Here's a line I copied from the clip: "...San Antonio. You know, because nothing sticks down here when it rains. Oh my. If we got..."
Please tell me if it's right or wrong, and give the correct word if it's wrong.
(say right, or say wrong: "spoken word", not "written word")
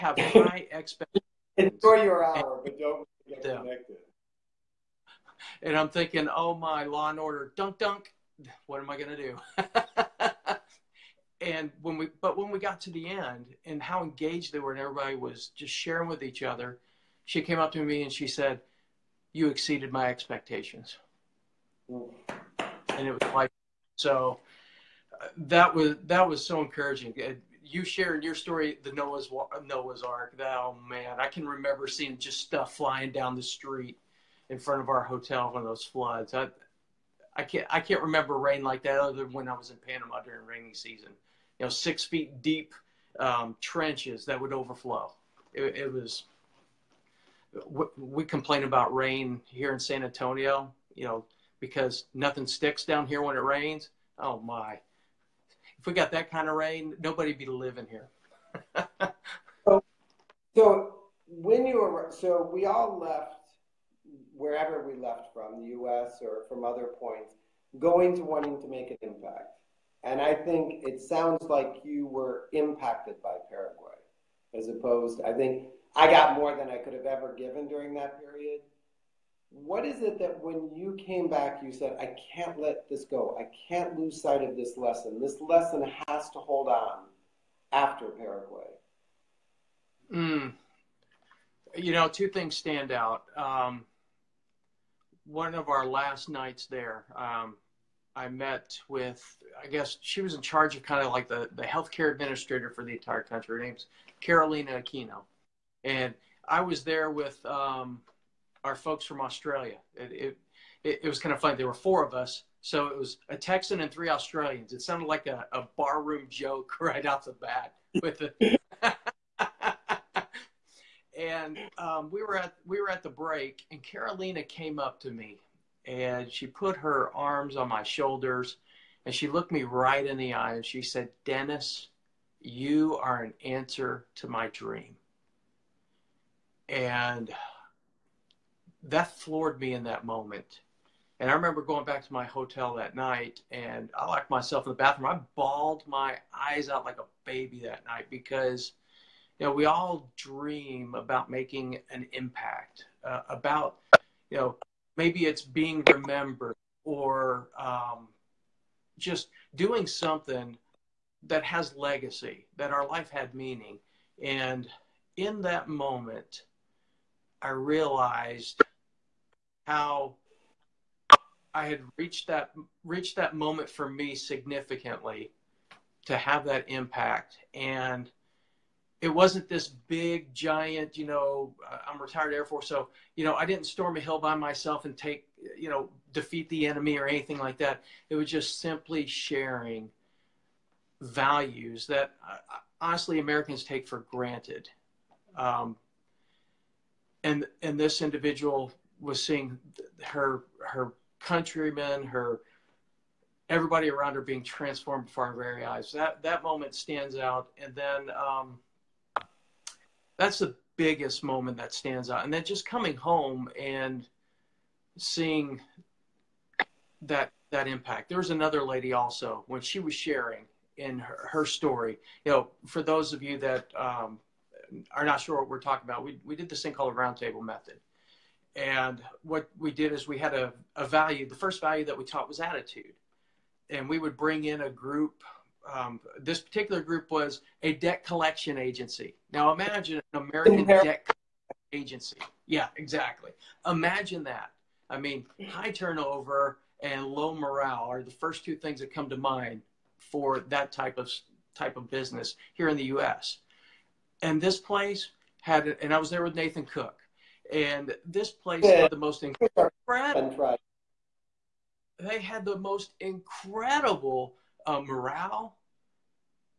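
right.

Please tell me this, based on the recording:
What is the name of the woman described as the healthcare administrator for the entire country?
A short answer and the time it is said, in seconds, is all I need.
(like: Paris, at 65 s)
Carolina Aquino, at 104 s.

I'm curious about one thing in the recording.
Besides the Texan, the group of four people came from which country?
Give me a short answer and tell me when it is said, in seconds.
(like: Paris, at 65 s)
Australia, at 109 s.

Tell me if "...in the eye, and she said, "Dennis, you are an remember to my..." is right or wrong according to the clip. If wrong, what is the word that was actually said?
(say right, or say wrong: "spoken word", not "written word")
wrong: "answer", not "remember".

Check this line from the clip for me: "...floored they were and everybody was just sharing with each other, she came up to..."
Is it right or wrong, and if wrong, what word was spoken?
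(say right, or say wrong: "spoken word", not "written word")
wrong: "engaged", not "floored".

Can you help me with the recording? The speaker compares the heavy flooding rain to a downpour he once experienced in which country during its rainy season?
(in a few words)
Panama.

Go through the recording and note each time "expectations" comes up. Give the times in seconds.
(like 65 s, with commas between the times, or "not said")
0 s, 20 s.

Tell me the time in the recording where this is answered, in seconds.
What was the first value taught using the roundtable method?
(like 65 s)
232 s.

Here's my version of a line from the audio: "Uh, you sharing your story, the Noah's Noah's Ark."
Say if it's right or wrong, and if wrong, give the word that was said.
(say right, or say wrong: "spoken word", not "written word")
right.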